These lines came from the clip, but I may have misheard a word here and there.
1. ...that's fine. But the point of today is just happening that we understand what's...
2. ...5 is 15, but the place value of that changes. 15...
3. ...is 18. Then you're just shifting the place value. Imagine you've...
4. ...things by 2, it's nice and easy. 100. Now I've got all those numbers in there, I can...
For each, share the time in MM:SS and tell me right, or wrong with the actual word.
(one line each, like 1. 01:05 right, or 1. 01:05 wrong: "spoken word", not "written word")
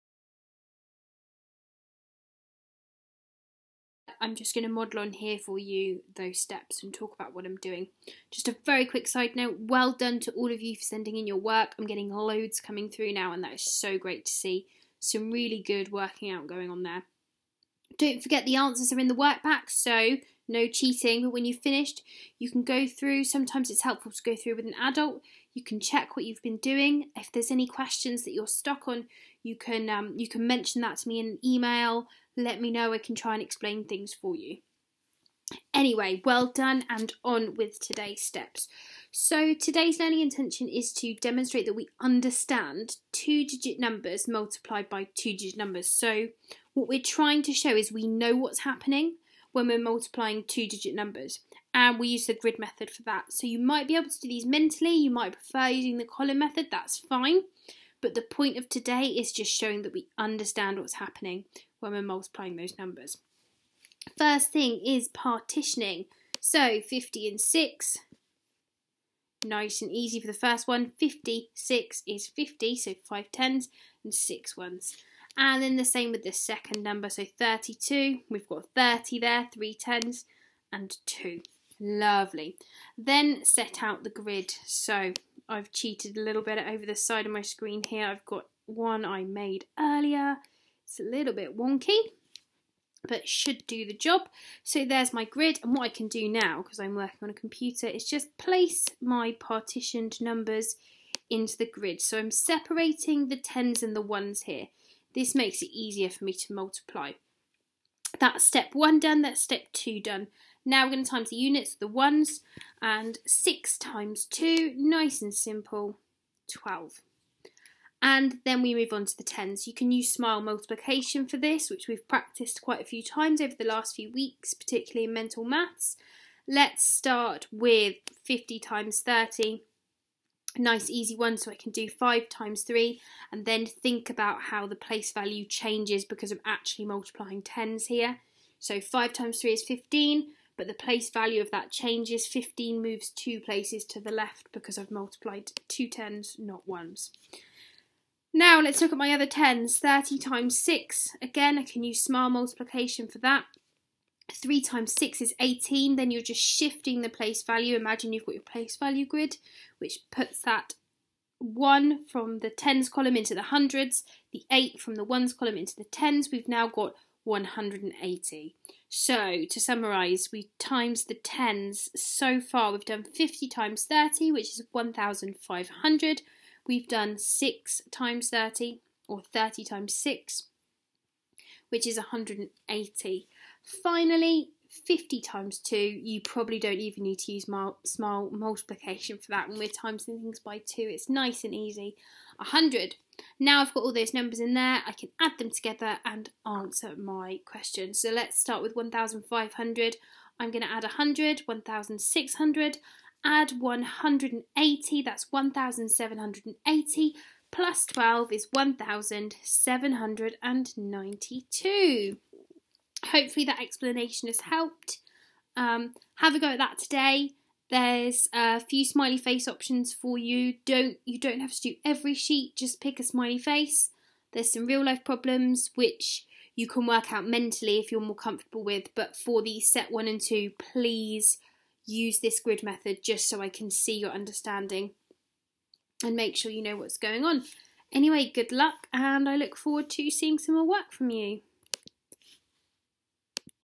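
1. 00:56 wrong: "showing", not "happening"
2. 02:19 wrong: "3", not "5"
3. 02:35 right
4. 03:10 right.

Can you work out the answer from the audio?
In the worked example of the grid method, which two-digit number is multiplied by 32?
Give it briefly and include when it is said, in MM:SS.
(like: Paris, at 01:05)
56, at 01:10.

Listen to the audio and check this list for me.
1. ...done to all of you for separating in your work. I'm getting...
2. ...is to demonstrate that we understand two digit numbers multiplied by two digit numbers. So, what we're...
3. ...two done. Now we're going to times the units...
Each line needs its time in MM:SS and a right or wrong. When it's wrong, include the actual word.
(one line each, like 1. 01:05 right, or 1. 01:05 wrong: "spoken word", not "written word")
1. 00:09 wrong: "sending", not "separating"
2. 00:40 right
3. 01:49 right.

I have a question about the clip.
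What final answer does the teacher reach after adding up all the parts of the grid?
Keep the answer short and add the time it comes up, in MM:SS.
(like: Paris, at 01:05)
1,792, at 03:28.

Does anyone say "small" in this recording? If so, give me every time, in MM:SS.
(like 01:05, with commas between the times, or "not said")
02:32, 03:07.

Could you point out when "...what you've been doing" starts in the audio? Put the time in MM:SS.
00:26.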